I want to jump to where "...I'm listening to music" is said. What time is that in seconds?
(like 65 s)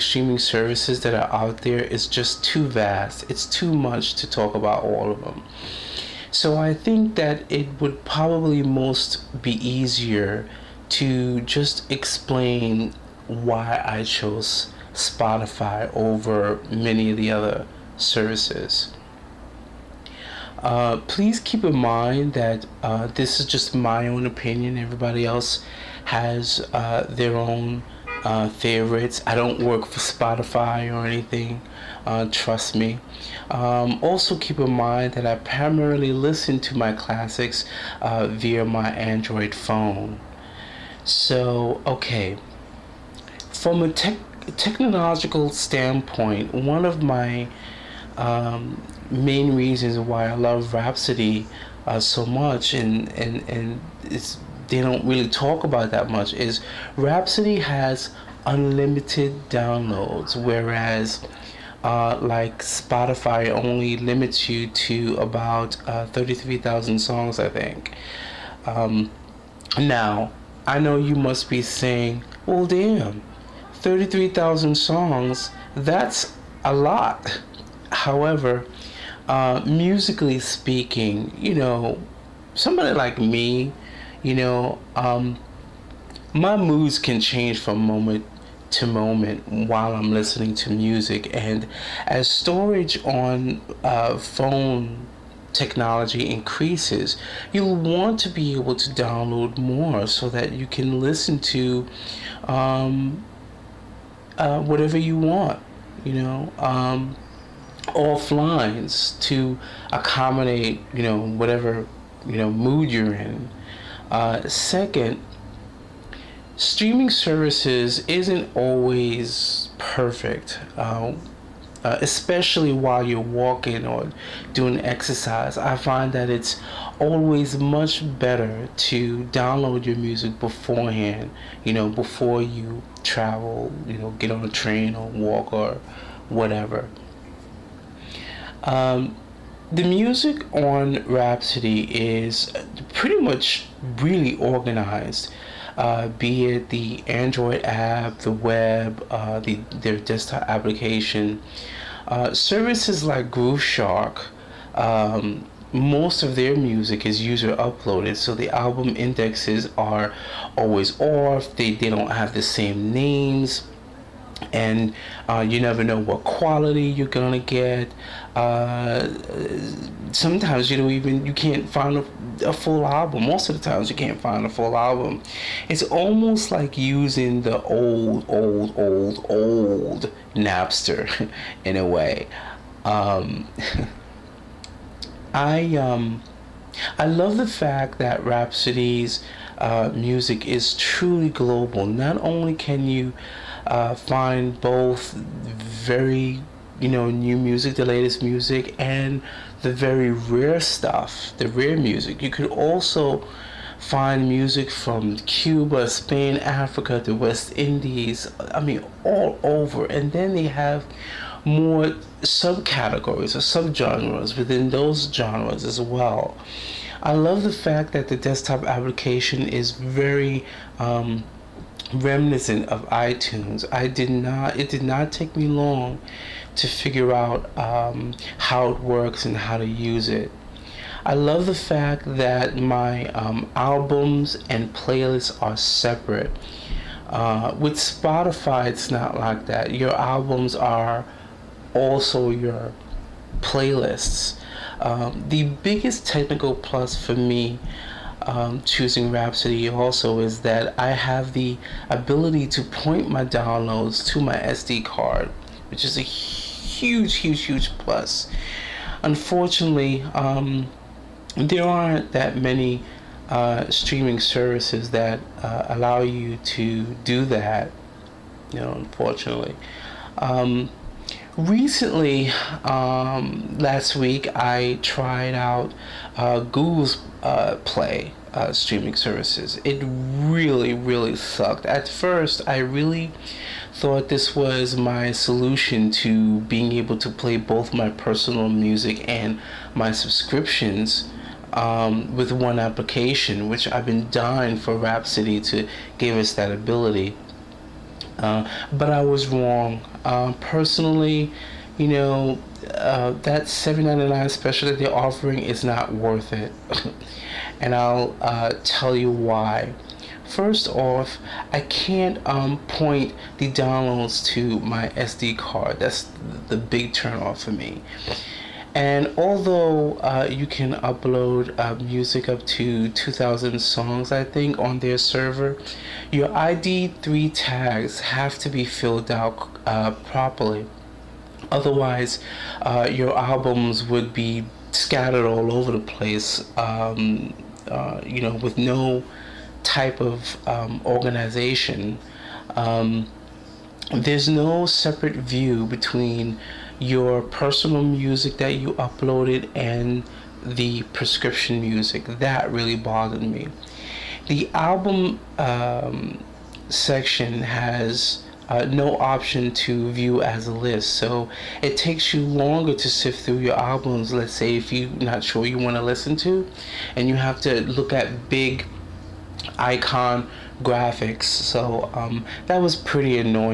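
89 s.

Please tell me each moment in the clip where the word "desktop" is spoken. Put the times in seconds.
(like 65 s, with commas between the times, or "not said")
149 s, 218 s.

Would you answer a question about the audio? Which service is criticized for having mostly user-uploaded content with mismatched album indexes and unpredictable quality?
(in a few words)
Grooveshark.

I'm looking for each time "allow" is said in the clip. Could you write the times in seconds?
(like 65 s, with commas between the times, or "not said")
265 s.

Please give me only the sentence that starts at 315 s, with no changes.
That's the big turnoff for me.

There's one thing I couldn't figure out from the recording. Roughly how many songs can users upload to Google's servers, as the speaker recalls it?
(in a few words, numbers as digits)
2,000.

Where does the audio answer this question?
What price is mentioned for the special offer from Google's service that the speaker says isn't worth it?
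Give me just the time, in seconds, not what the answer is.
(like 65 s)
303 s.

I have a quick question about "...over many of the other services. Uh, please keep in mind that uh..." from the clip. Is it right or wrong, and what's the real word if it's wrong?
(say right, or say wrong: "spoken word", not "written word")
right.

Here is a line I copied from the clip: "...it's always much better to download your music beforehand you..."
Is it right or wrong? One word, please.
right.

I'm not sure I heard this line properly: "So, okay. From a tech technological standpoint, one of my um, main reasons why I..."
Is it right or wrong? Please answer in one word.
right.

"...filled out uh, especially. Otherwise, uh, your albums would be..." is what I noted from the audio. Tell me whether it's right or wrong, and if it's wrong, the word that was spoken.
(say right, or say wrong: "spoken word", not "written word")
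wrong: "properly", not "especially".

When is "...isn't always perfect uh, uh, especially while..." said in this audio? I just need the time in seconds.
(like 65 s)
118 s.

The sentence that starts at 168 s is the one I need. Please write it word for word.
Uh, sometimes you don't even you can't find a, a, full album.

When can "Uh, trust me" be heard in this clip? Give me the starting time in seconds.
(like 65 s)
32 s.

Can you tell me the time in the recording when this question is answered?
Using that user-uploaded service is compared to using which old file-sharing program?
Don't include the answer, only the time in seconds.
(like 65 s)
180 s.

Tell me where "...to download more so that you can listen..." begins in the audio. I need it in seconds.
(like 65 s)
98 s.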